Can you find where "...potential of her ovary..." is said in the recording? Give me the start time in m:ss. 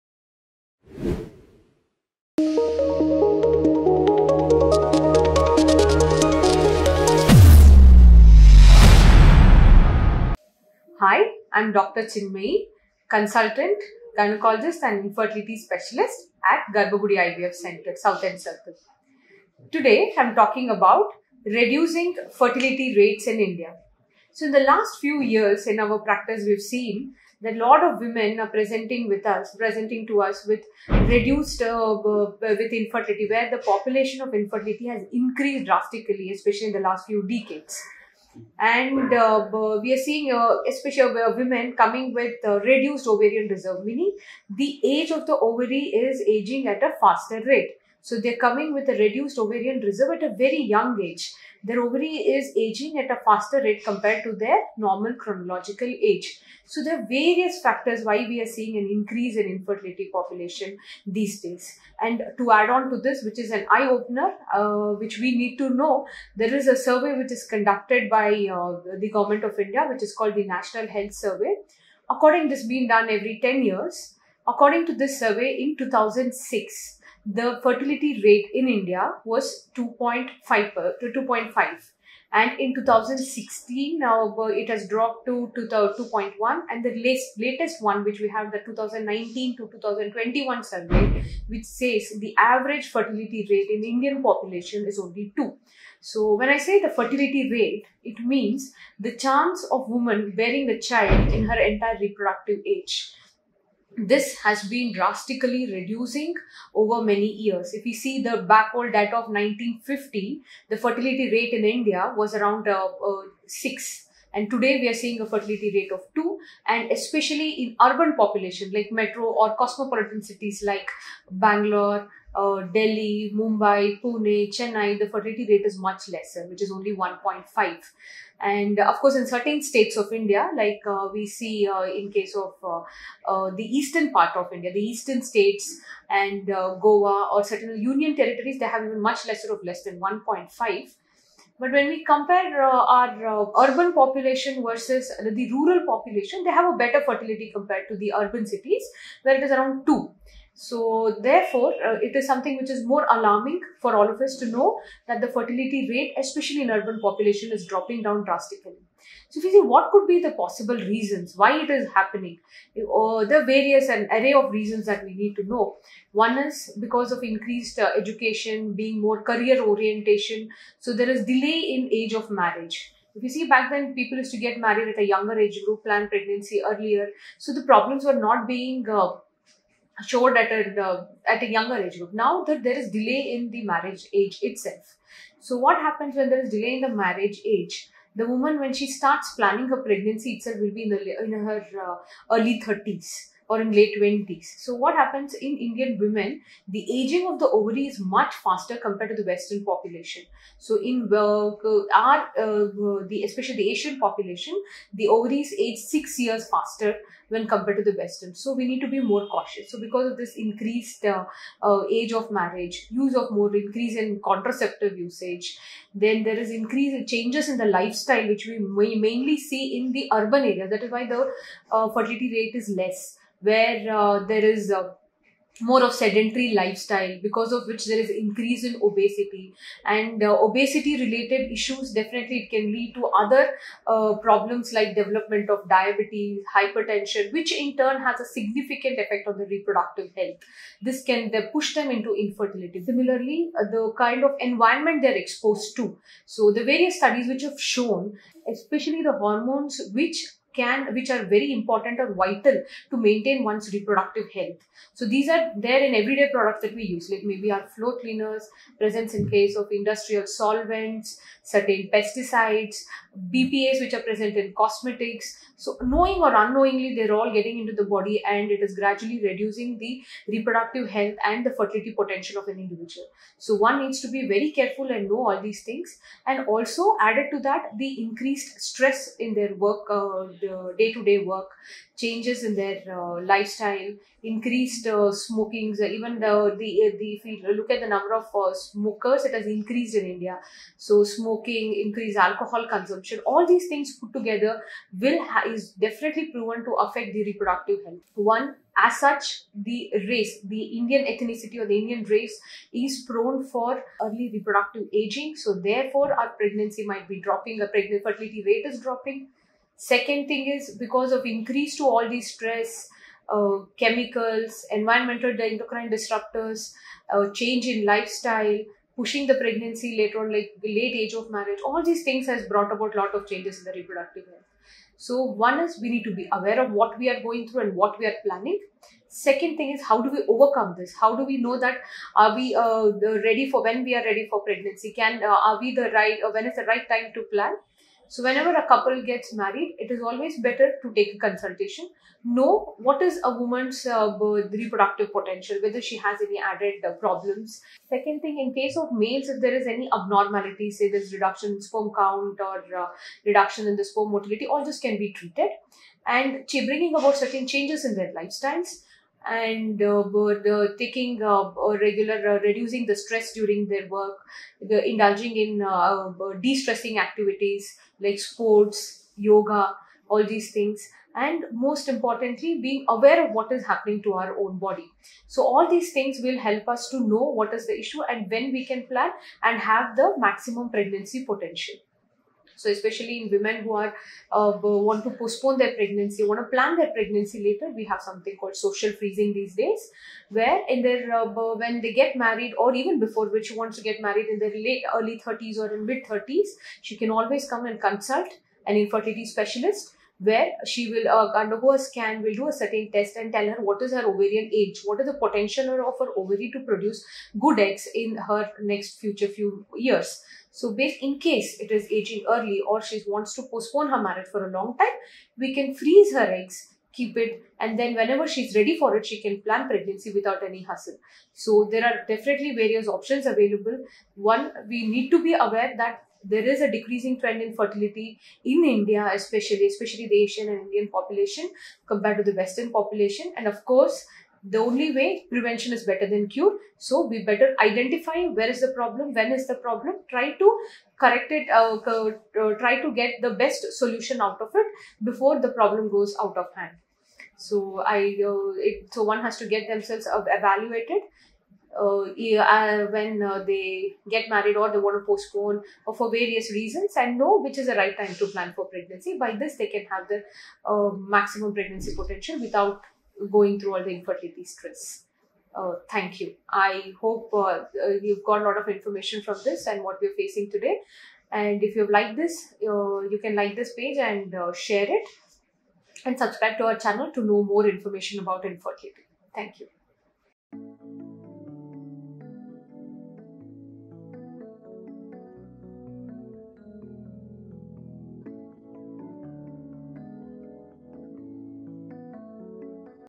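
6:45.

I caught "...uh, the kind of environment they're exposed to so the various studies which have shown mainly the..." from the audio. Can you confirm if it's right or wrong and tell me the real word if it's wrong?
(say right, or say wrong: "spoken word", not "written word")
wrong: "especially", not "mainly".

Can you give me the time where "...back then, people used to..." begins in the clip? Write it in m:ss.
2:53.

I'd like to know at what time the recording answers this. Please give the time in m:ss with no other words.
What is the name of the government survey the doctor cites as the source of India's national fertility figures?
1:10.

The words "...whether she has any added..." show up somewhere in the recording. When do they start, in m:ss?
5:45.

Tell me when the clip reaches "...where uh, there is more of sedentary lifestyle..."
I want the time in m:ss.
3:43.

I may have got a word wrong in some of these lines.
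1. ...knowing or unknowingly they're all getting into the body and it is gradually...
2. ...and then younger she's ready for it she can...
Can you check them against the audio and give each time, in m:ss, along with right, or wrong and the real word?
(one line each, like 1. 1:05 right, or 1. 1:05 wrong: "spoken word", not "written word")
1. 4:25 right
2. 6:57 wrong: "whenever", not "younger".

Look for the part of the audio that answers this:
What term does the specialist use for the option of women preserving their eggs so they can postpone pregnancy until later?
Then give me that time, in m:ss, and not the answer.
6:28.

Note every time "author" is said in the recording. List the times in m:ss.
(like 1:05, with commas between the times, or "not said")
not said.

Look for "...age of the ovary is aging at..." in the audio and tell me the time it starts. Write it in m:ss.
0:44.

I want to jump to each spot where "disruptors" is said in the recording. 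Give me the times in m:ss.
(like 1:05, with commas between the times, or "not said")
5:15.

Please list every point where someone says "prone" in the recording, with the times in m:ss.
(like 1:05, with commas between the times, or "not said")
5:03.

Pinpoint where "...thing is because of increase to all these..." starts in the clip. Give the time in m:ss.
5:10.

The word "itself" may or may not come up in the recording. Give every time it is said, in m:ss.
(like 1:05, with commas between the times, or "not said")
3:04, 3:10.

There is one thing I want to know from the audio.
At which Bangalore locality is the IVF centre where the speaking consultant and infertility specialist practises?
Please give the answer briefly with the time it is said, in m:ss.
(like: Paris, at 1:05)
South End Circle, at 0:17.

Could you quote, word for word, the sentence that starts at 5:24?
So one is we need to be aware of what we are going through and what we are planning.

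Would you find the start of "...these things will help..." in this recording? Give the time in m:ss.
6:15.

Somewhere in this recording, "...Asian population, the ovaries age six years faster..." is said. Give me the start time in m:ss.
3:23.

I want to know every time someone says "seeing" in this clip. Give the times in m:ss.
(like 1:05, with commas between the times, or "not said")
0:39, 0:58, 1:54.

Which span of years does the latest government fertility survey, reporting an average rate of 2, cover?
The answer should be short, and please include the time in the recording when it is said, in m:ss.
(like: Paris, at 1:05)
2019 to 2021, at 1:28.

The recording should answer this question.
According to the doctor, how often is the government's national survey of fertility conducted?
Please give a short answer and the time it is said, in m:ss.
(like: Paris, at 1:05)
Every 10 years, at 1:13.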